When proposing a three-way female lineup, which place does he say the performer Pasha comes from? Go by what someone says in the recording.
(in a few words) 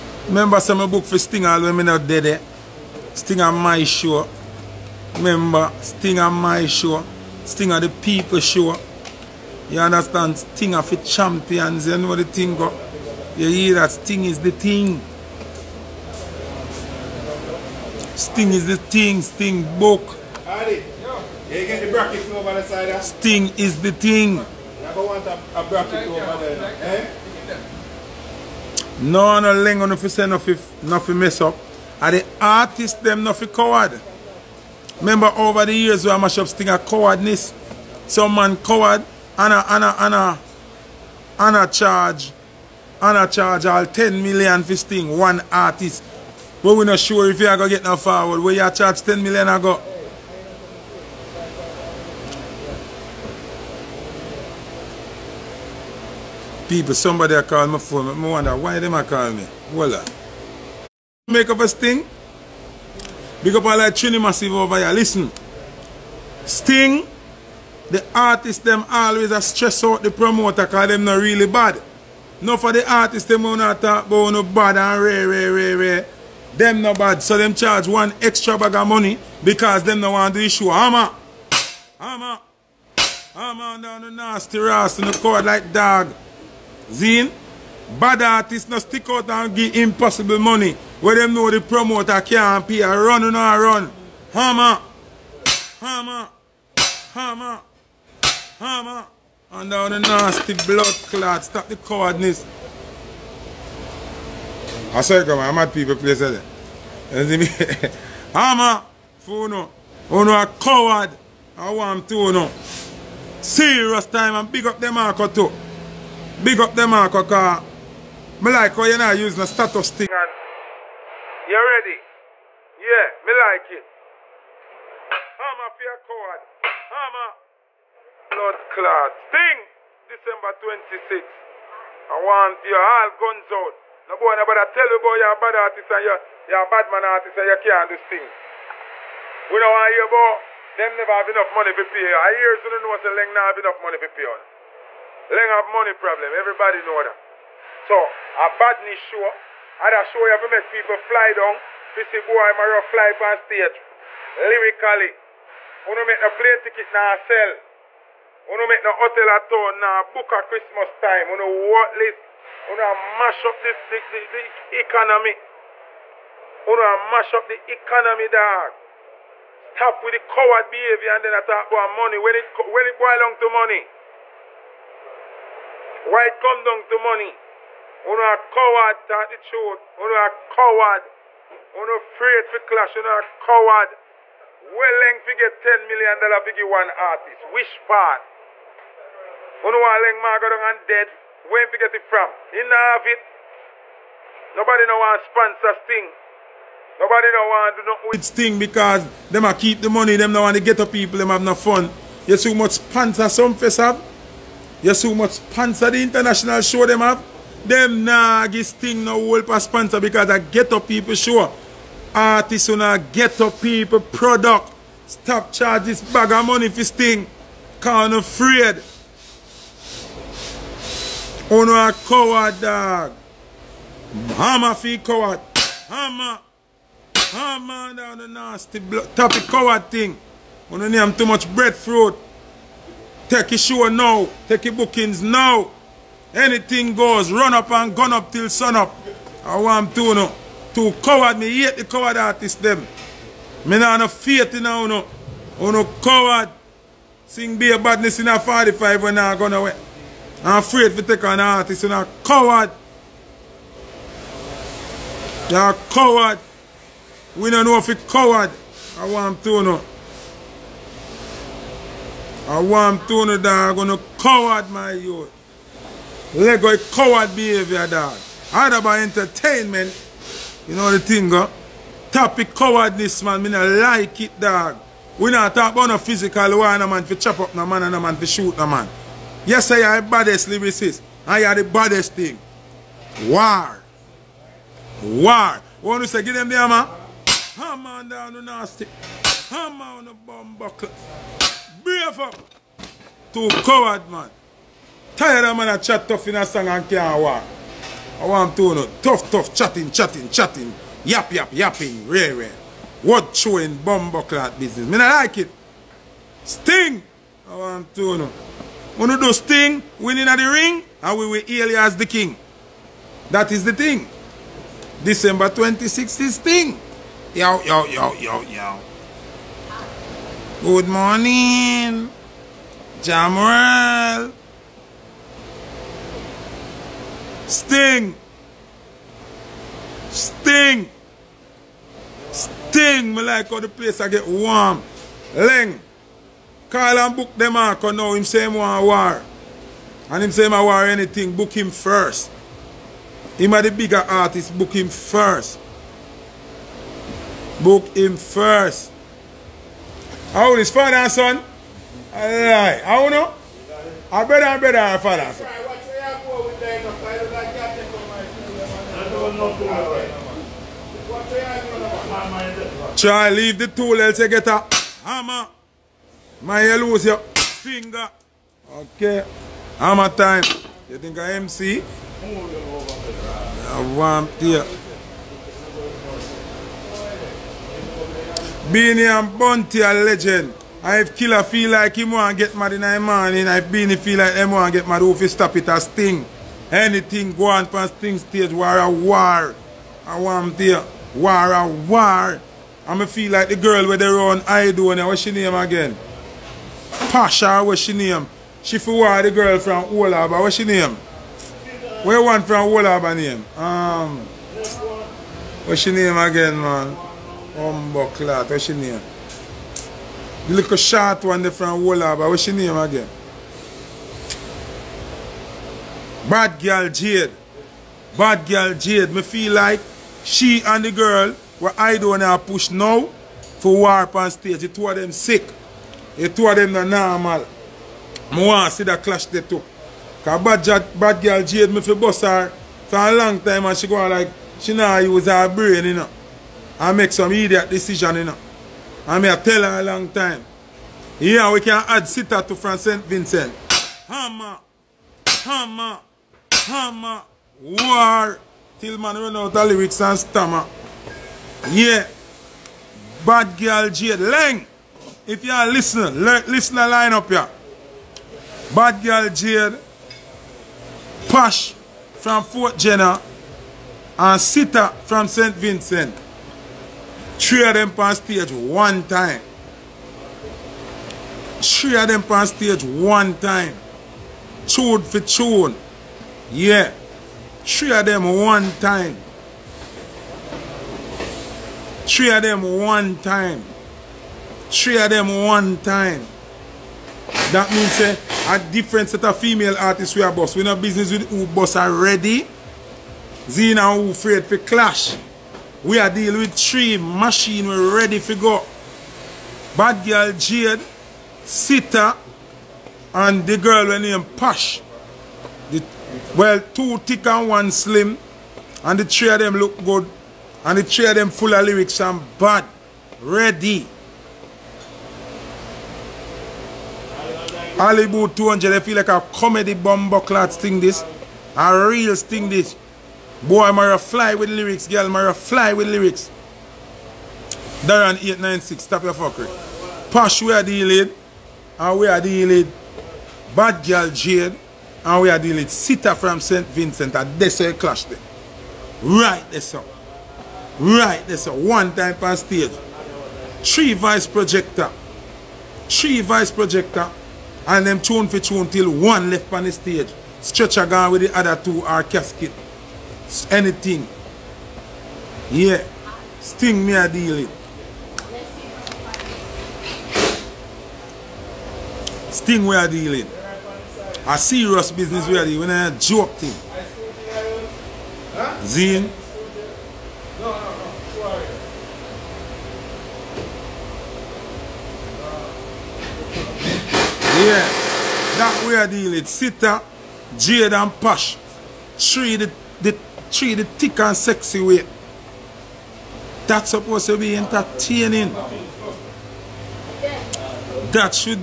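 Fort Jenner.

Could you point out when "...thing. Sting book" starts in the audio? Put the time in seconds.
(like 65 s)
18 s.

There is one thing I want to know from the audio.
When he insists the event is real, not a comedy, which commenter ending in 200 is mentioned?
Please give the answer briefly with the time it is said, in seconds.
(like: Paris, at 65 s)
Hollywood 200, at 517 s.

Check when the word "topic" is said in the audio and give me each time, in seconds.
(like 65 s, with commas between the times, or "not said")
229 s, 272 s.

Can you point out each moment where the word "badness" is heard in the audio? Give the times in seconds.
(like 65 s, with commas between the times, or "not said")
148 s, 247 s.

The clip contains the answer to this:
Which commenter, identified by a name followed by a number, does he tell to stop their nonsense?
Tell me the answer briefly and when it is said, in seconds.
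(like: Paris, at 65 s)
Darren 896, at 527 s.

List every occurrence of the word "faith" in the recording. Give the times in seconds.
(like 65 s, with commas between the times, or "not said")
244 s.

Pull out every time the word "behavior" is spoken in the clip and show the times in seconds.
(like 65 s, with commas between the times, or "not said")
170 s, 267 s.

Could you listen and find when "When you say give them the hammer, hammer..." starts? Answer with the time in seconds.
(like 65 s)
285 s.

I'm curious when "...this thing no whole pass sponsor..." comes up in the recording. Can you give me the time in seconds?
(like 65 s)
208 s.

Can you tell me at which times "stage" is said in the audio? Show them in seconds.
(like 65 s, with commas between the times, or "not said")
153 s, 388 s, 424 s, 468 s, 472 s, 542 s, 549 s.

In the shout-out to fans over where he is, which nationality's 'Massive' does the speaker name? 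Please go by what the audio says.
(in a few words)
Trini.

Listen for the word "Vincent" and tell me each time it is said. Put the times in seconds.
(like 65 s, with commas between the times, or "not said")
443 s, 465 s, 536 s.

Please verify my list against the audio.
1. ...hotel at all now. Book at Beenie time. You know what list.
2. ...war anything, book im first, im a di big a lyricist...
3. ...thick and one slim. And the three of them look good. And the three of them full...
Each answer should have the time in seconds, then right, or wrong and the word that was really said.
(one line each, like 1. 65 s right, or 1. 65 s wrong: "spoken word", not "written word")
1. 158 s wrong: "Christmas", not "Beenie"
2. 340 s wrong: "artist", not "lyricist"
3. 506 s right.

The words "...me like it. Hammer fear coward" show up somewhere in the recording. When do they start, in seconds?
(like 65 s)
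123 s.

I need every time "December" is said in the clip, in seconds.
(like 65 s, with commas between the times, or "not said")
130 s, 315 s.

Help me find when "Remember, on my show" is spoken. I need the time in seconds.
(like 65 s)
5 s.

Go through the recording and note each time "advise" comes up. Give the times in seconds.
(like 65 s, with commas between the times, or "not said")
not said.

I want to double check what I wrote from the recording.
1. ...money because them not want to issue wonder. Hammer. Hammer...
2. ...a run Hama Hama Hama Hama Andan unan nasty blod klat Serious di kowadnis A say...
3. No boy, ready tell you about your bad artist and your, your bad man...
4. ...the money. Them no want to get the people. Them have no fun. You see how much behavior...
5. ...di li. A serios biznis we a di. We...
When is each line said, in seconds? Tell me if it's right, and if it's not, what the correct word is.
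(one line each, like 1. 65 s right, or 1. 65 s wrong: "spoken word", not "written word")
1. 78 s wrong: "hammer", not "wonder"
2. 93 s wrong: "Stap", not "Serious"
3. 134 s wrong: "nobody", not "ready"
4. 199 s wrong: "sponsor", not "behavior"
5. 562 s right.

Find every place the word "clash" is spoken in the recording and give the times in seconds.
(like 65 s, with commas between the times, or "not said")
182 s, 537 s.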